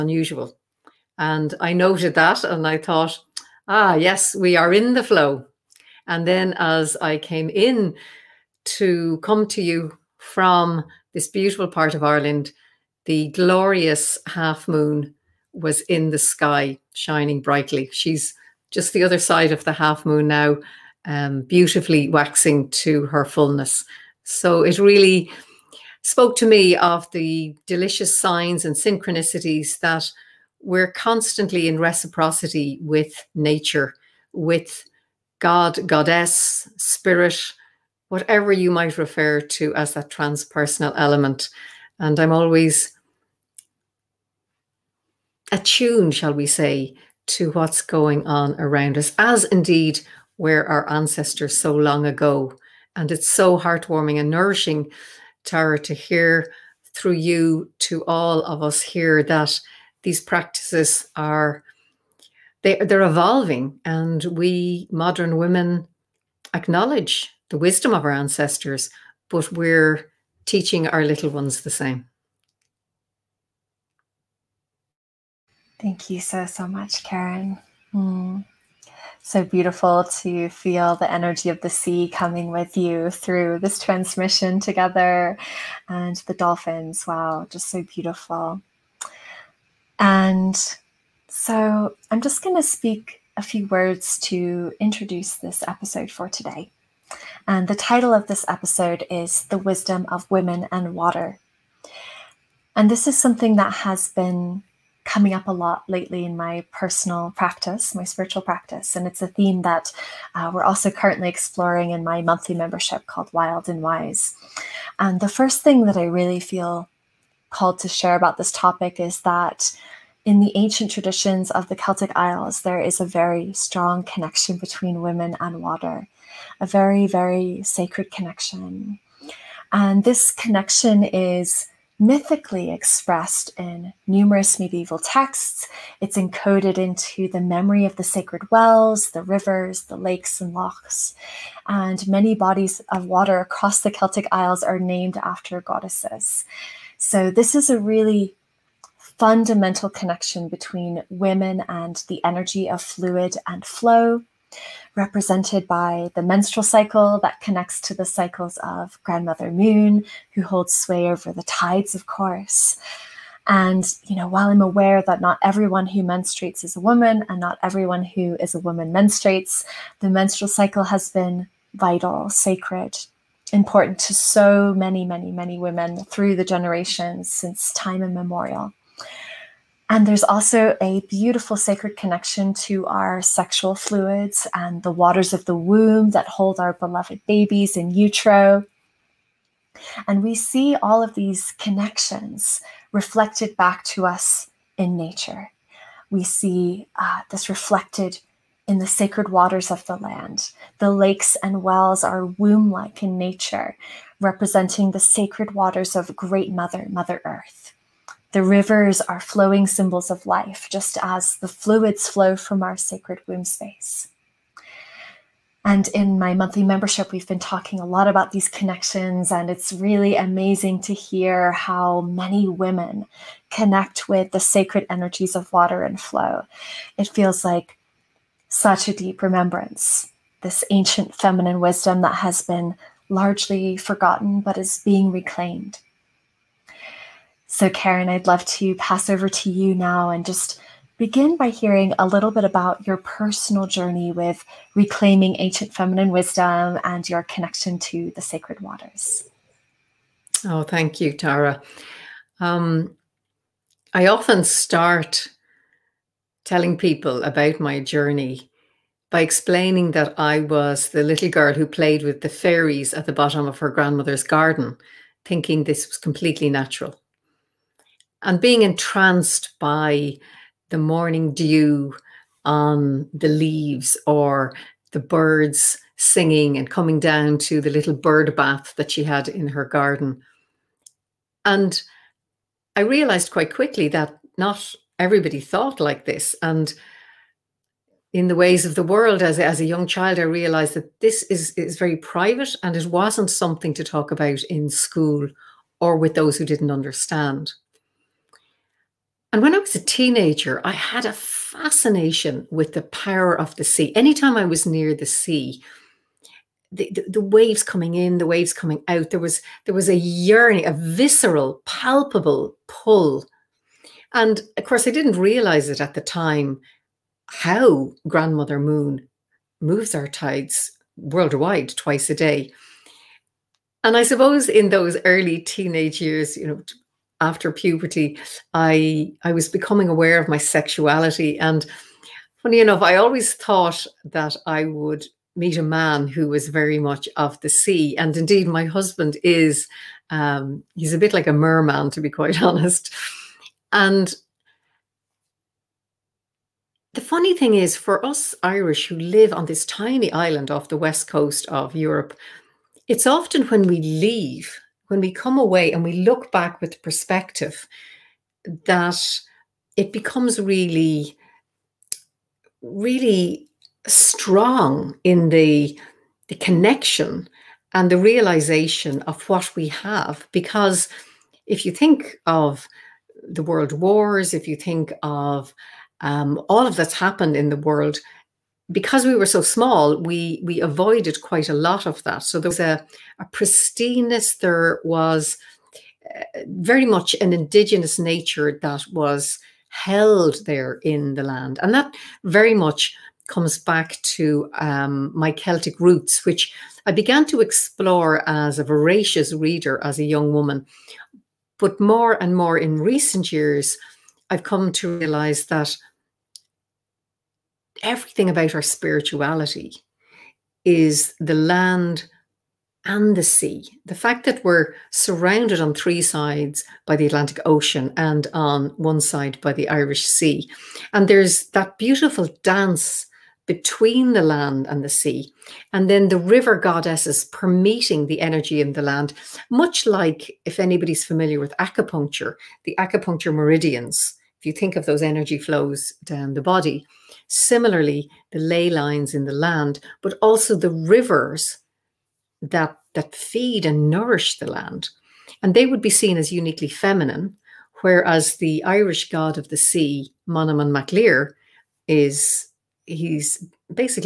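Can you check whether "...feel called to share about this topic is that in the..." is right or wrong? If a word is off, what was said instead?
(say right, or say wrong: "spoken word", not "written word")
right.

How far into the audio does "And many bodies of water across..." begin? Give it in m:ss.
2:21.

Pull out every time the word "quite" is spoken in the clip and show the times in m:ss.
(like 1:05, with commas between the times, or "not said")
4:43, 5:42, 6:21.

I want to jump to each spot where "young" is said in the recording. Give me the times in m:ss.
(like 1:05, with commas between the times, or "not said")
4:49, 6:40.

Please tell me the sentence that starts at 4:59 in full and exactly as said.
And when I was a teenager, I had a fascination with the power of the sea.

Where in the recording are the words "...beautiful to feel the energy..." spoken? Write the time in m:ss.
1:19.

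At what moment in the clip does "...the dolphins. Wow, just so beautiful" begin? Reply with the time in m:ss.
1:26.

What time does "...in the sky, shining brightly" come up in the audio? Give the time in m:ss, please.
0:15.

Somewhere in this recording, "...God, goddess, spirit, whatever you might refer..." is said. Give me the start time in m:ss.
0:35.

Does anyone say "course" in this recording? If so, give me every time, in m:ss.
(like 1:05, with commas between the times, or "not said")
2:42, 5:14.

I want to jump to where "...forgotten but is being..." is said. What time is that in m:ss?
3:53.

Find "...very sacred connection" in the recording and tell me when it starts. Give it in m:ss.
2:07.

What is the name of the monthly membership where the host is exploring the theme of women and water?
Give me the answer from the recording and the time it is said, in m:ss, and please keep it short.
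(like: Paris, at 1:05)
Wild and Wise, at 1:53.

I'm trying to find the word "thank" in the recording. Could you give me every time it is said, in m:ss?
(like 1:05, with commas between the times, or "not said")
1:15, 4:10.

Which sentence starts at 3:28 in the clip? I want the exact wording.
The rivers are flowing symbols of life, just as the fluids flow from our sacred womb space.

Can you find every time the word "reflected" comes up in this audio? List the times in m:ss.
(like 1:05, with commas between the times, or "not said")
3:12, 3:17.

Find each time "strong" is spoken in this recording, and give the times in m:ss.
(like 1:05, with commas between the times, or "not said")
2:03, 6:03.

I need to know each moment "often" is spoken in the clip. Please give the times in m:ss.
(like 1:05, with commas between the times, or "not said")
4:14, 5:53.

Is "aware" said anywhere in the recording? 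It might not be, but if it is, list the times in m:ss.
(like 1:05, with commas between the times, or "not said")
2:44, 5:29.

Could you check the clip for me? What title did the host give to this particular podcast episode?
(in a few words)
The Wisdom of Women and Water.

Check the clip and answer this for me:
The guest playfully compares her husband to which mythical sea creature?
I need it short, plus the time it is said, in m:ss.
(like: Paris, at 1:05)
Merman, at 5:41.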